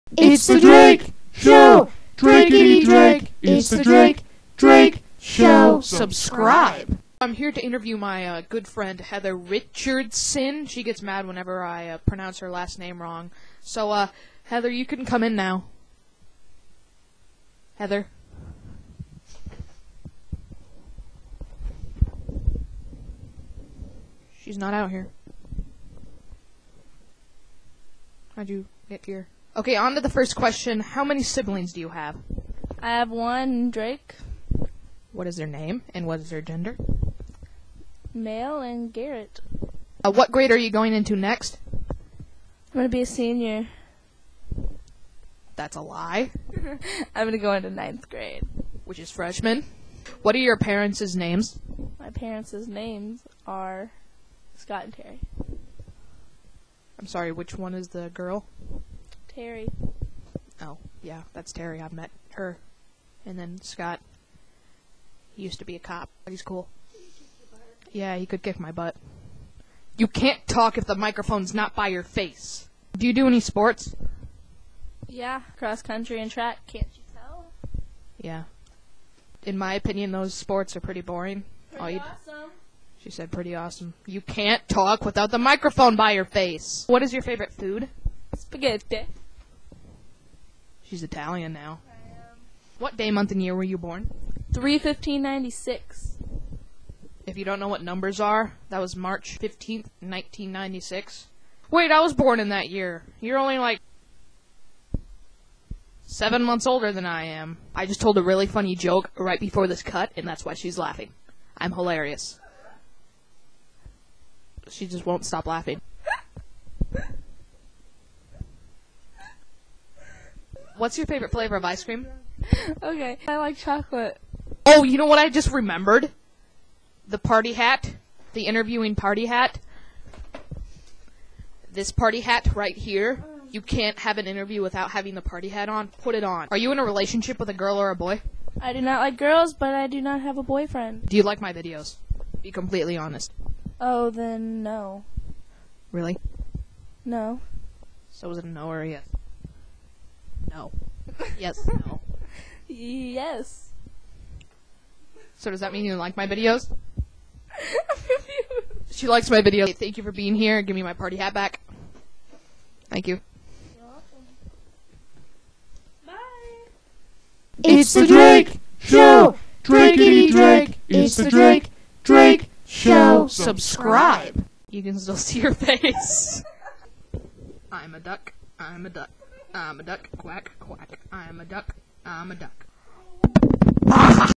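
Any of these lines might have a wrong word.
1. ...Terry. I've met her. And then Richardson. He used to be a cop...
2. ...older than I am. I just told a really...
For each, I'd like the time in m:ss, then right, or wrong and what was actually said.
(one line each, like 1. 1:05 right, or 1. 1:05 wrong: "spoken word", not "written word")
1. 1:01 wrong: "Scott", not "Richardson"
2. 1:46 right.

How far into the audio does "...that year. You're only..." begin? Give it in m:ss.
1:42.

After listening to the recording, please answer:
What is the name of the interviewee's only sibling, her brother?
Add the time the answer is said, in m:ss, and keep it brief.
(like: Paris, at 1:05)
Garrett, at 0:38.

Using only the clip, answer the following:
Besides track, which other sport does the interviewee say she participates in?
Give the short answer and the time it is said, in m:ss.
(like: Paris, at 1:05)
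Cross country, at 1:15.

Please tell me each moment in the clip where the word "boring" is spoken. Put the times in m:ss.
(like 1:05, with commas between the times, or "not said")
1:21.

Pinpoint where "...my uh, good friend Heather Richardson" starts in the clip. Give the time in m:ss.
0:07.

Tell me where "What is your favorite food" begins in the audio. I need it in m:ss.
1:26.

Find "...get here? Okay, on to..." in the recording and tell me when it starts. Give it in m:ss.
0:28.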